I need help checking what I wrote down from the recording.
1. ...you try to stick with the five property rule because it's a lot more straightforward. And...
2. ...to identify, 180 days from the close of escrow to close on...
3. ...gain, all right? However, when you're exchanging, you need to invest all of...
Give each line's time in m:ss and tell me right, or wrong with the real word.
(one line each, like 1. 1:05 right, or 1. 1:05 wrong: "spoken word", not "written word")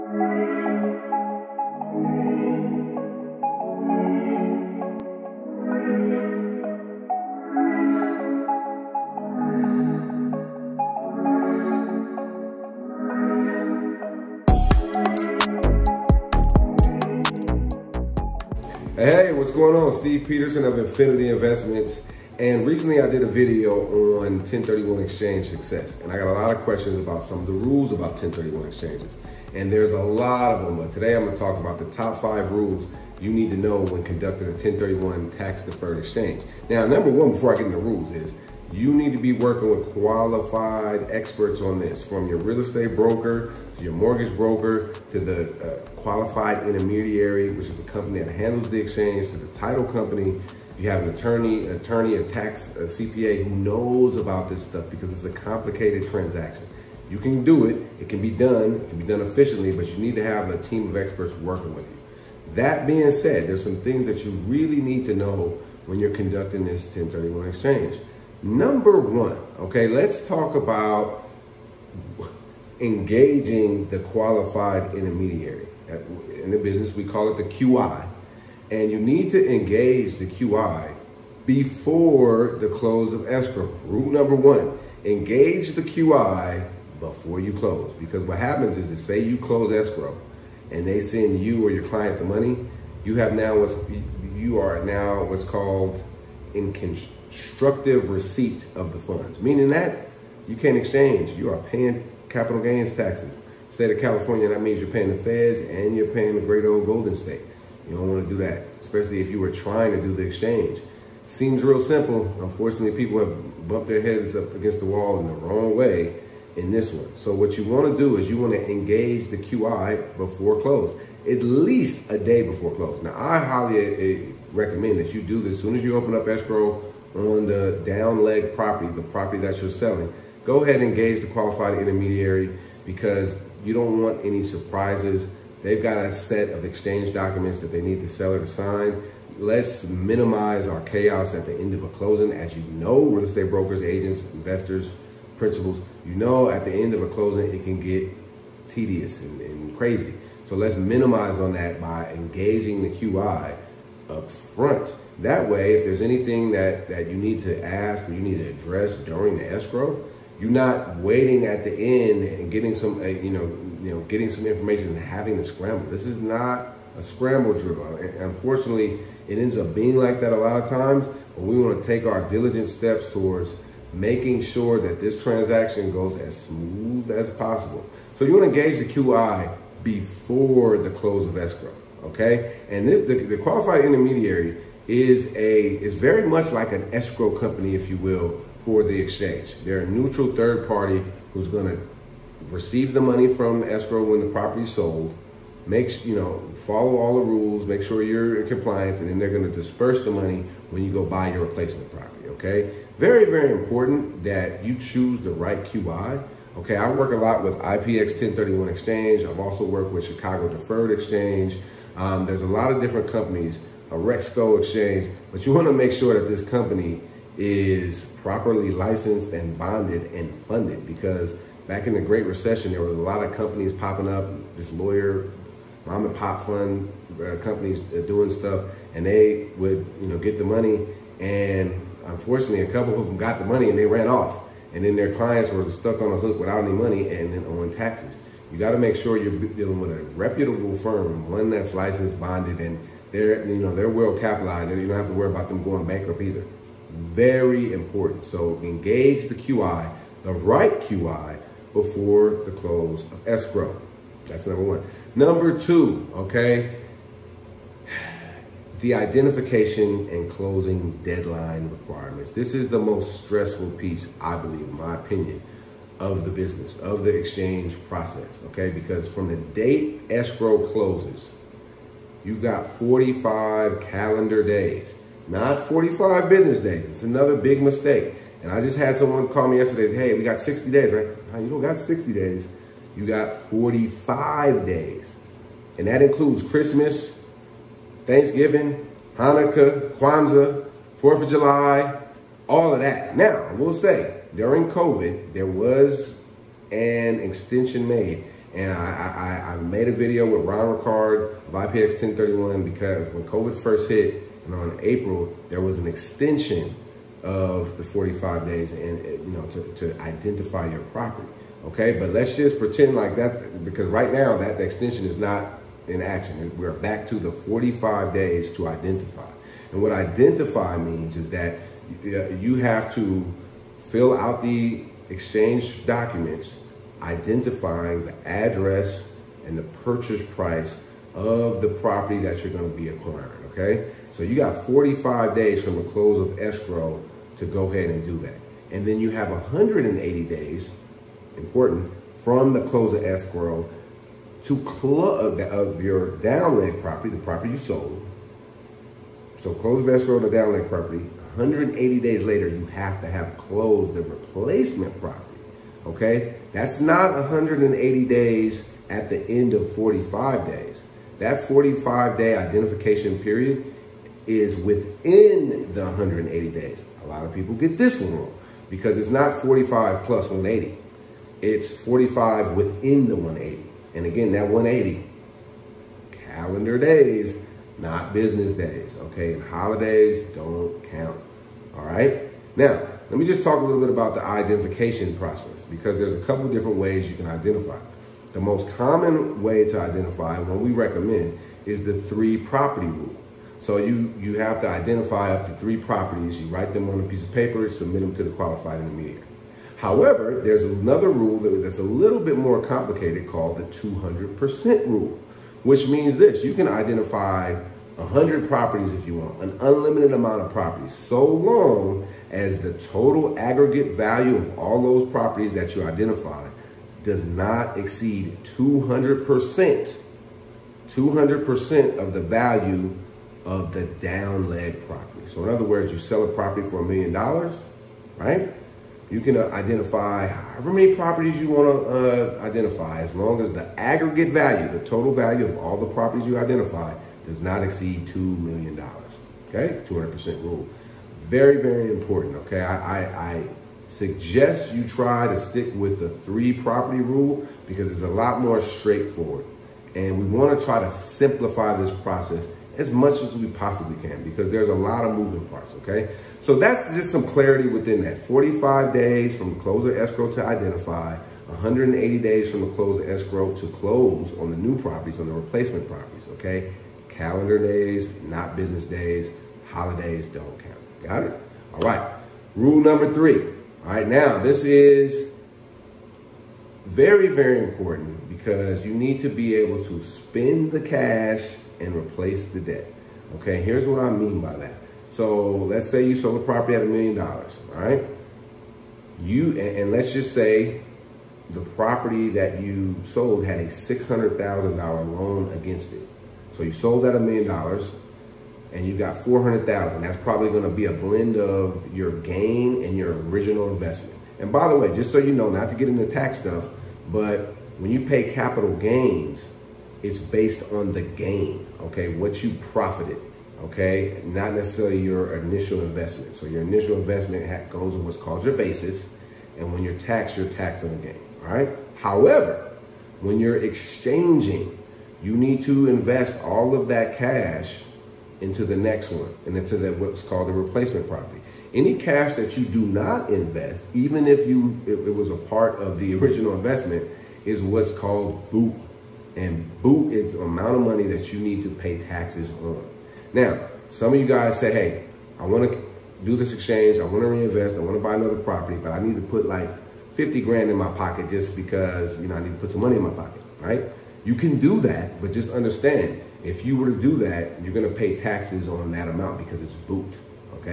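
1. 7:24 wrong: "three", not "five"
2. 7:40 right
3. 8:41 right.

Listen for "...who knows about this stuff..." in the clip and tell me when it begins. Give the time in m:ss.
0:53.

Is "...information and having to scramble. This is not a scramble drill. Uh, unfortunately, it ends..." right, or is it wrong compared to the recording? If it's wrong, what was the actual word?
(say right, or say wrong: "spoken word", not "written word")
right.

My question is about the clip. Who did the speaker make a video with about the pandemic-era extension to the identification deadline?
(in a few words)
Ron Ricard.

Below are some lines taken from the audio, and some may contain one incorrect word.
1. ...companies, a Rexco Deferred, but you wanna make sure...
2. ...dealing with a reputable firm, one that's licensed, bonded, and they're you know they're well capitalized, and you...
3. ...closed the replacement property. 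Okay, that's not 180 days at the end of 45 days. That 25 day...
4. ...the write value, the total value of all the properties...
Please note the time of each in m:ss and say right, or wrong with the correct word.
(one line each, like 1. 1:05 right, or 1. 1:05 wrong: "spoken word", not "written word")
1. 3:33 wrong: "Exchange", not "Deferred"
2. 3:59 right
3. 5:53 wrong: "45", not "25"
4. 7:13 wrong: "aggregate", not "write".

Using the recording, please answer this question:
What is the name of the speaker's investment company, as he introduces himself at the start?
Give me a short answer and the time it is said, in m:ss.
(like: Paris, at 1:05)
Infinity Investments, at 0:20.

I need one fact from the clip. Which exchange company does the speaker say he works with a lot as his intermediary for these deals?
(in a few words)
IPX 1031 Exchange.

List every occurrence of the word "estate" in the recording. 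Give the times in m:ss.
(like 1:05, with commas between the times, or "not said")
0:42, 2:23.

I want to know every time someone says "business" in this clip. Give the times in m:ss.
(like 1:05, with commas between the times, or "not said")
1:16, 4:26, 4:36, 6:18, 7:48.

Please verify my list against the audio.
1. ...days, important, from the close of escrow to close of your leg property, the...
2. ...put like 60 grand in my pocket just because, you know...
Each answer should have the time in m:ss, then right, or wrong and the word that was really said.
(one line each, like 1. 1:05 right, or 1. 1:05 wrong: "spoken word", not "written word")
1. 5:40 right
2. 9:09 wrong: "50", not "60".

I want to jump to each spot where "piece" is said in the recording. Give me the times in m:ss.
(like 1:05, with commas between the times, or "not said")
4:23, 6:37.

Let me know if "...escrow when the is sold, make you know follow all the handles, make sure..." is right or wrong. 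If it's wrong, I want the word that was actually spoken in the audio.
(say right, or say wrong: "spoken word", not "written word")
wrong: "rules", not "handles".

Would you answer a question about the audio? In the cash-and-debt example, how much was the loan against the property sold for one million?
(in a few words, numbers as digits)
$600,000.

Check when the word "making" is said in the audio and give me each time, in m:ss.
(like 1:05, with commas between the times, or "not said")
2:53.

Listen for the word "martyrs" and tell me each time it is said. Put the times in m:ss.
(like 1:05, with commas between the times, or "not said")
not said.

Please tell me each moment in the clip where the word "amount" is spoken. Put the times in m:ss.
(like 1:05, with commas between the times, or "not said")
6:50, 9:00, 9:19.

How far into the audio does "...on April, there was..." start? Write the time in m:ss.
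5:04.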